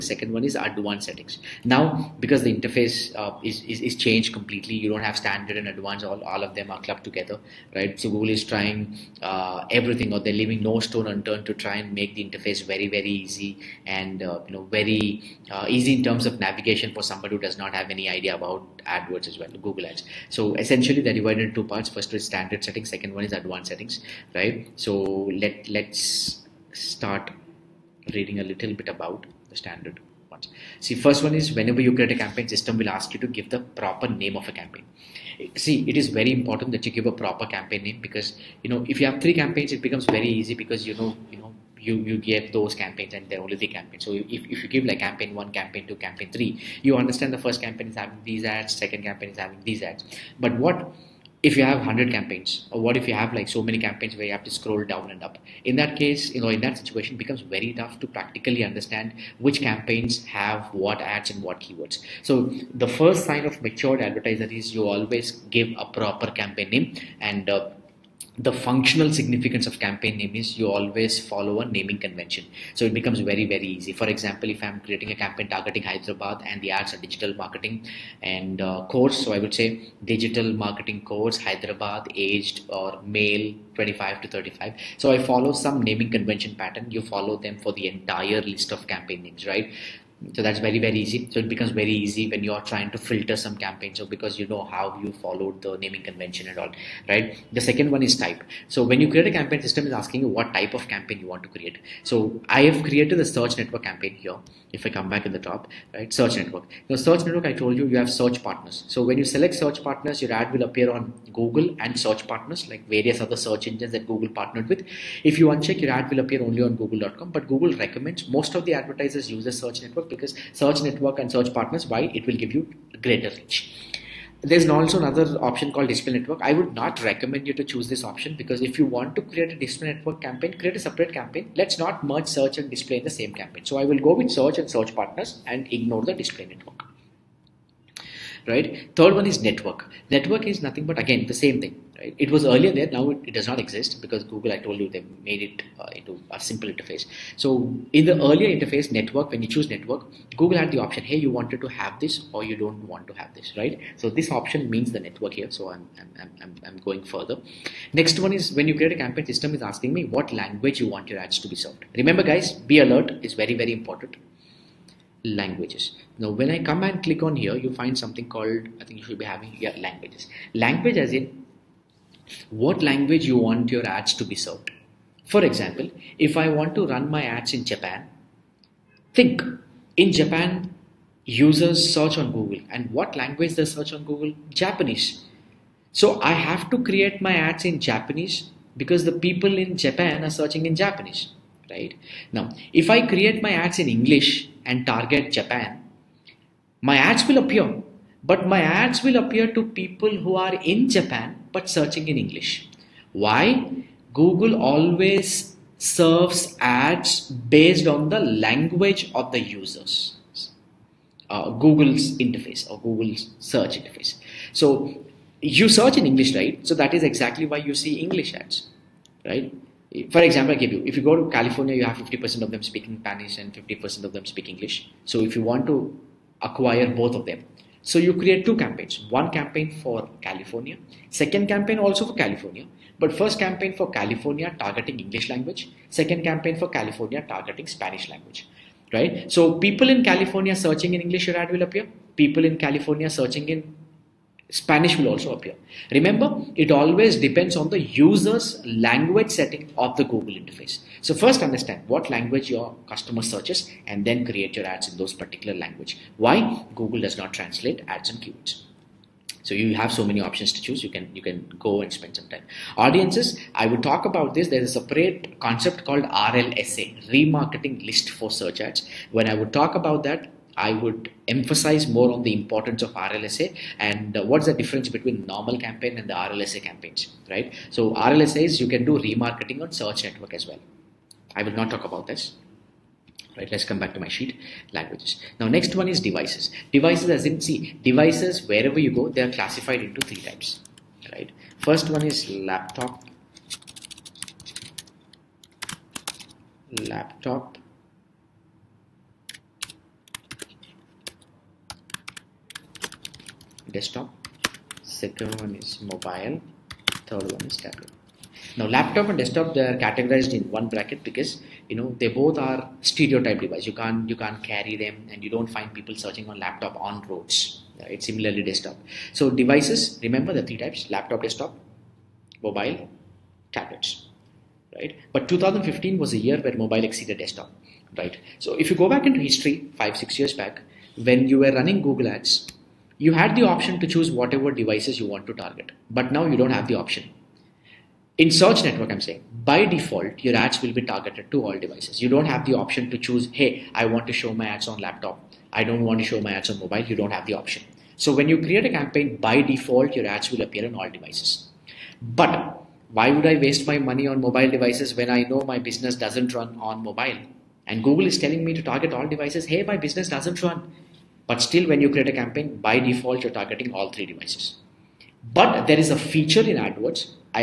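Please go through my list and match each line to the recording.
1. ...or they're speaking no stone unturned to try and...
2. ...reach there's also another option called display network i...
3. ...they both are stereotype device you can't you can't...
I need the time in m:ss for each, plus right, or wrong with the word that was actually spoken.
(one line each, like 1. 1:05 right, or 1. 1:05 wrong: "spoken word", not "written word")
1. 0:10 wrong: "leaving", not "speaking"
2. 2:03 right
3. 5:11 right.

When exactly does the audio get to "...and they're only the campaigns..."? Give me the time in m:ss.
0:43.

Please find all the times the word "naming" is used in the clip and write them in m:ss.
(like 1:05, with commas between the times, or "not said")
1:11, 1:25, 1:35.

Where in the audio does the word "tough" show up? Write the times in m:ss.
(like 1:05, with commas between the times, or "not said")
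0:57.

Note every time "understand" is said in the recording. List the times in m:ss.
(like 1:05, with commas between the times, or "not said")
0:47, 0:58, 4:11.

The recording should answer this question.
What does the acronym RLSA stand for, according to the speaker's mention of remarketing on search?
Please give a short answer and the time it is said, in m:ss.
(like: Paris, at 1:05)
remarketing list for search ads, at 4:27.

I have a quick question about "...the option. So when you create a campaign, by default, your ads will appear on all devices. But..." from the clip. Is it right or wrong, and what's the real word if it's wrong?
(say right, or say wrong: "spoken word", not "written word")
right.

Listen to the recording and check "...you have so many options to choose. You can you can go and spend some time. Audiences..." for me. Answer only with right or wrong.
right.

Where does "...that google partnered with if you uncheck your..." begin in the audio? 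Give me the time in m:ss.
1:53.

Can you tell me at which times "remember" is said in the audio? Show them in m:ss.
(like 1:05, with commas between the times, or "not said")
2:41, 4:05, 5:20.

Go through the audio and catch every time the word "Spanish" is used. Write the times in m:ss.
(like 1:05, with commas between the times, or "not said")
3:42, 3:57, 4:04.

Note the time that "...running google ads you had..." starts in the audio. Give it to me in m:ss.
5:31.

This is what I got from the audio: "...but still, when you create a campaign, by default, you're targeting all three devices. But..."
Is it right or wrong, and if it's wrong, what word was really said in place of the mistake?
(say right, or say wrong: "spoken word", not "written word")
right.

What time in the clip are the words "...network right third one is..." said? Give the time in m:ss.
2:16.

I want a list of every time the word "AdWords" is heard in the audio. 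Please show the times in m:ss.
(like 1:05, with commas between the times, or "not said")
0:18, 6:06.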